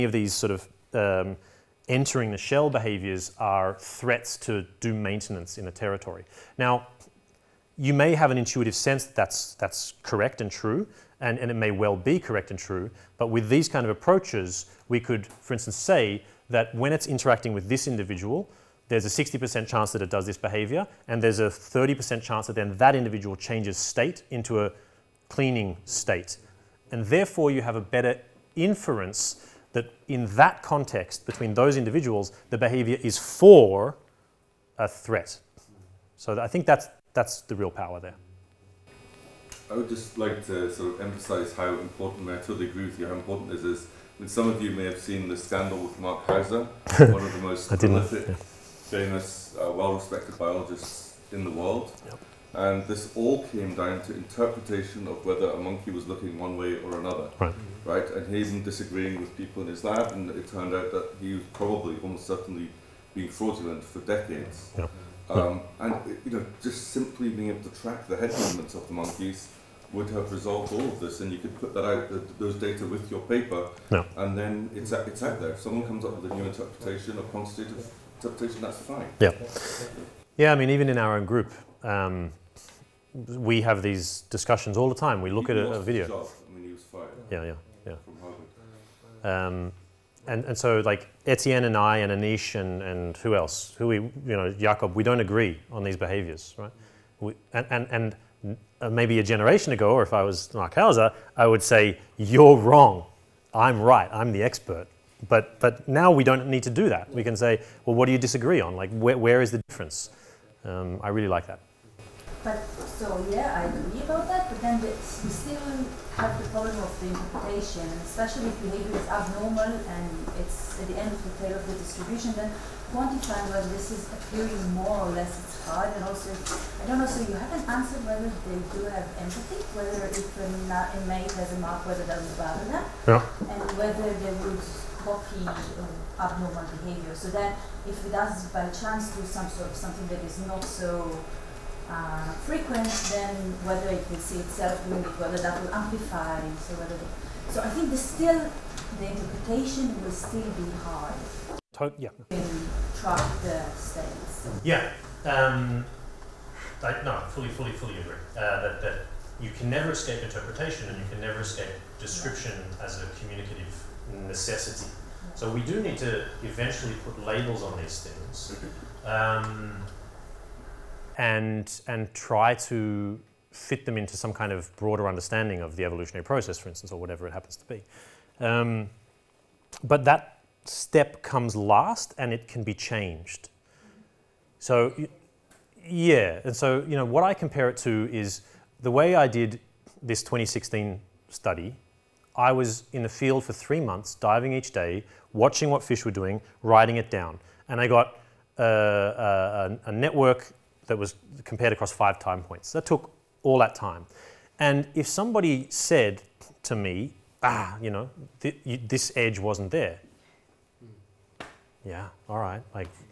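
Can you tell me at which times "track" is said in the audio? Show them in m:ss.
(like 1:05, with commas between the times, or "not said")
1:07, 2:32.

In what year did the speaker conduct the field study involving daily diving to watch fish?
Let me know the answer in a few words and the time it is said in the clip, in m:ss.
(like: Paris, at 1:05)
2016, at 3:10.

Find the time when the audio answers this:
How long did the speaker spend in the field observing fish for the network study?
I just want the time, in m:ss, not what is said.
3:13.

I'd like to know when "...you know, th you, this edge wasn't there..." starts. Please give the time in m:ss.
3:27.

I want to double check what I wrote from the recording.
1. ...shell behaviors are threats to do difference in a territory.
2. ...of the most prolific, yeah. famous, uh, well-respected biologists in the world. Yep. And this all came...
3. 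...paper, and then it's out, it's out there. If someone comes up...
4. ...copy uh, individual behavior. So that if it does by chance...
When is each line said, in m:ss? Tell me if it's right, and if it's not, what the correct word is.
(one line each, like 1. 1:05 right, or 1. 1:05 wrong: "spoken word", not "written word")
1. 0:02 wrong: "maintenance", not "difference"
2. 0:47 right
3. 1:13 right
4. 2:14 wrong: "abnormal", not "individual".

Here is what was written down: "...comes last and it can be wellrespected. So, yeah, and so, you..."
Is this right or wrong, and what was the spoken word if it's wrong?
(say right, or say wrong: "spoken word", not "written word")
wrong: "changed", not "wellrespected".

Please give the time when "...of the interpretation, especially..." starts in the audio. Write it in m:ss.
1:56.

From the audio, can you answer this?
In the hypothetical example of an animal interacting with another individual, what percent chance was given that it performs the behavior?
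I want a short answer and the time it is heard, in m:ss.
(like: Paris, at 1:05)
60%, at 0:19.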